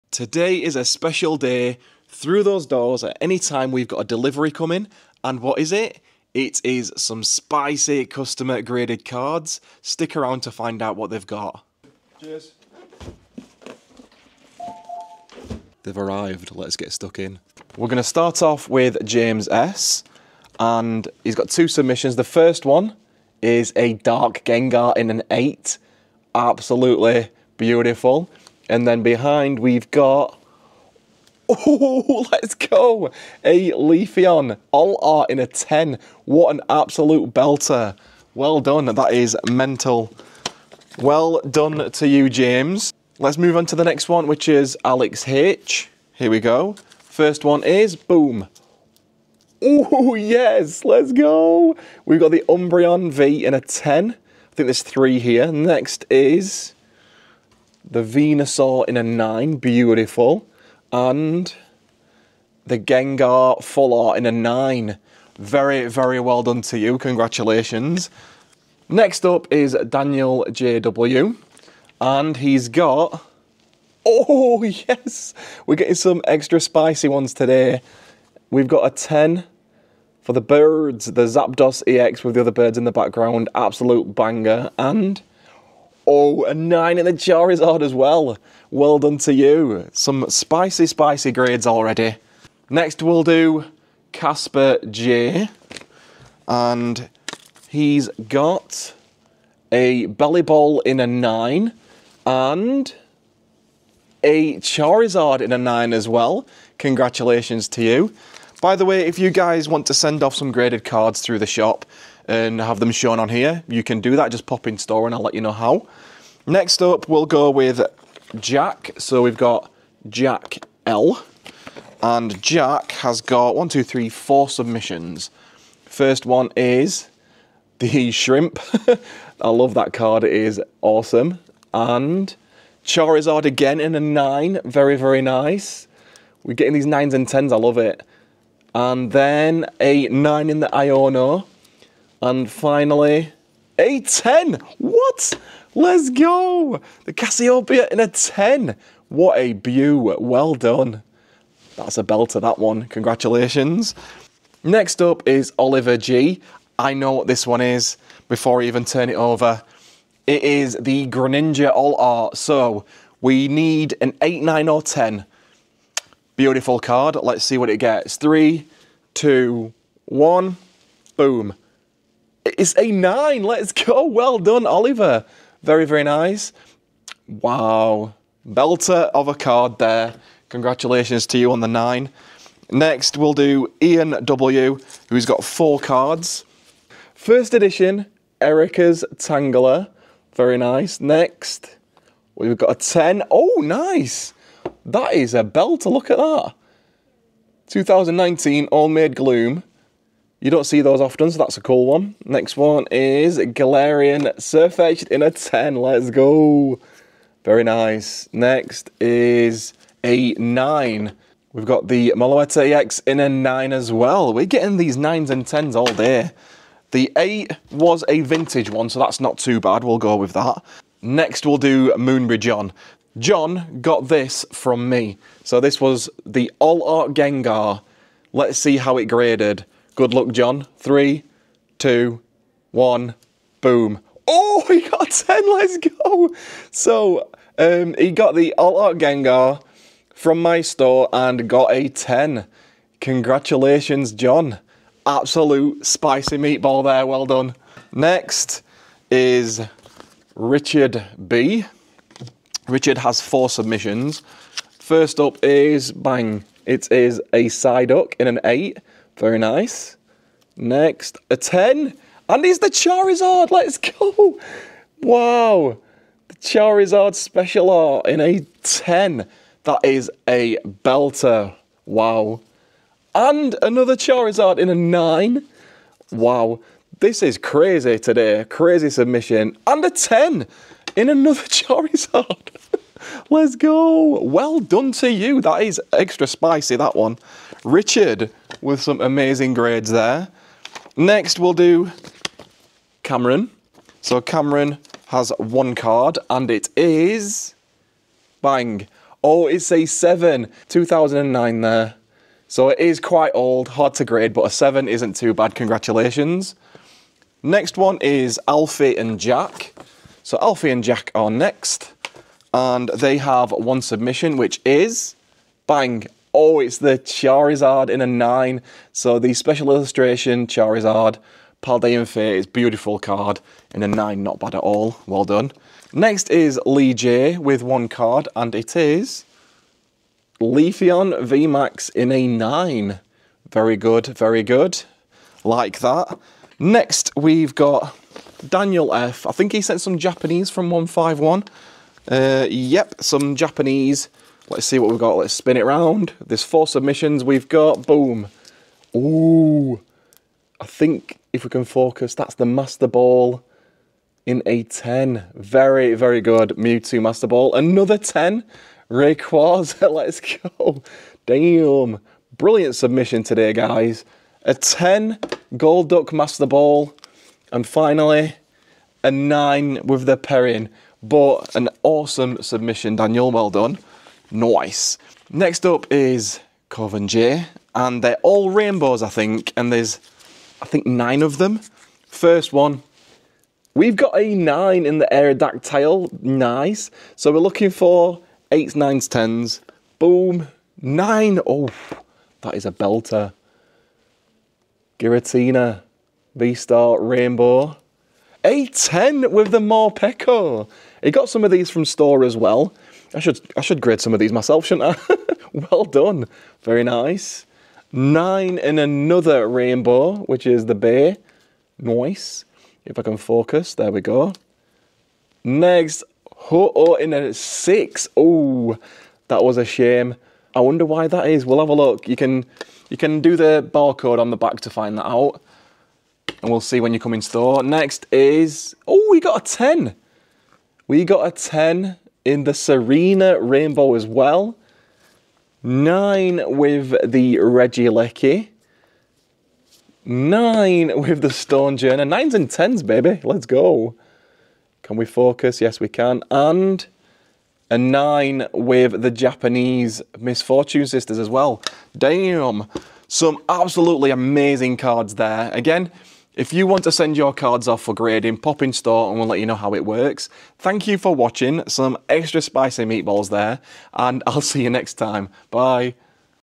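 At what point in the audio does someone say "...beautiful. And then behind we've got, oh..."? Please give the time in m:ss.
0:27.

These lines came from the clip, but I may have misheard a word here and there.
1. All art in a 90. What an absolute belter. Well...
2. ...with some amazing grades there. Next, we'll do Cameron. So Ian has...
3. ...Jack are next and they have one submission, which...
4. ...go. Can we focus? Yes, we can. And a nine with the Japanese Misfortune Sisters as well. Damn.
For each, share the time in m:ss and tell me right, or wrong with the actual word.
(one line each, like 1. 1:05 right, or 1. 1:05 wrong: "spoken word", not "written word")
1. 0:34 wrong: "10", not "90"
2. 4:48 wrong: "Cameron", not "Ian"
3. 5:10 right
4. 7:23 right.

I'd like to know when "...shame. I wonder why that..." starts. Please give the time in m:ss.
6:59.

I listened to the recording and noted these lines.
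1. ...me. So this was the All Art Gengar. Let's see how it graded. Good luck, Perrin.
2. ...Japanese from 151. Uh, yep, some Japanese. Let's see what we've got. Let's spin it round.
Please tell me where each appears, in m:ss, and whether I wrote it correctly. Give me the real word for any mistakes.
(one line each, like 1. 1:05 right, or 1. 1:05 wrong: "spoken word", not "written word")
1. 3:44 wrong: "John", not "Perrin"
2. 5:39 right.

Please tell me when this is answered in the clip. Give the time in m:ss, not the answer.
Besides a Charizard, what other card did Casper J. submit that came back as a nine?
1:40.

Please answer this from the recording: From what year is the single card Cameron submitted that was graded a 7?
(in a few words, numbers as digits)
2009.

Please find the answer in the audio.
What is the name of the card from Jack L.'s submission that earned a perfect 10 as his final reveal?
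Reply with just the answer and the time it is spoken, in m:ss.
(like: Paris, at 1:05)
Cassiopeia, at 2:27.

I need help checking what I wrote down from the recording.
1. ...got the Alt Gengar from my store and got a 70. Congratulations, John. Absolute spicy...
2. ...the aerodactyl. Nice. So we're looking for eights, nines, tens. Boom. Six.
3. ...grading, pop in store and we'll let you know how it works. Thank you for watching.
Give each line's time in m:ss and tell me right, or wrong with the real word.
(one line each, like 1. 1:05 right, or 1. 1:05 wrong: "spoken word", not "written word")
1. 3:58 wrong: "10", not "70"
2. 6:24 wrong: "Nine", not "Six"
3. 7:37 right.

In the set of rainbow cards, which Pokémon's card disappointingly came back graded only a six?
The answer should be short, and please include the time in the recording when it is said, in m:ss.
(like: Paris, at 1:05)
Ho-Oh, at 6:56.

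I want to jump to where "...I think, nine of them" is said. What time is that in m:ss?
6:20.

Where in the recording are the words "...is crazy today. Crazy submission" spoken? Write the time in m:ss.
4:37.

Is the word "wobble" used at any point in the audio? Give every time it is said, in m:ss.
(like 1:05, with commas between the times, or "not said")
not said.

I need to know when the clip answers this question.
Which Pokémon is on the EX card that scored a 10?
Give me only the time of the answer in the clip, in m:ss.
1:21.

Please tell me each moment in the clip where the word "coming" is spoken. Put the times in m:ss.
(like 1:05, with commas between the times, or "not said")
0:04.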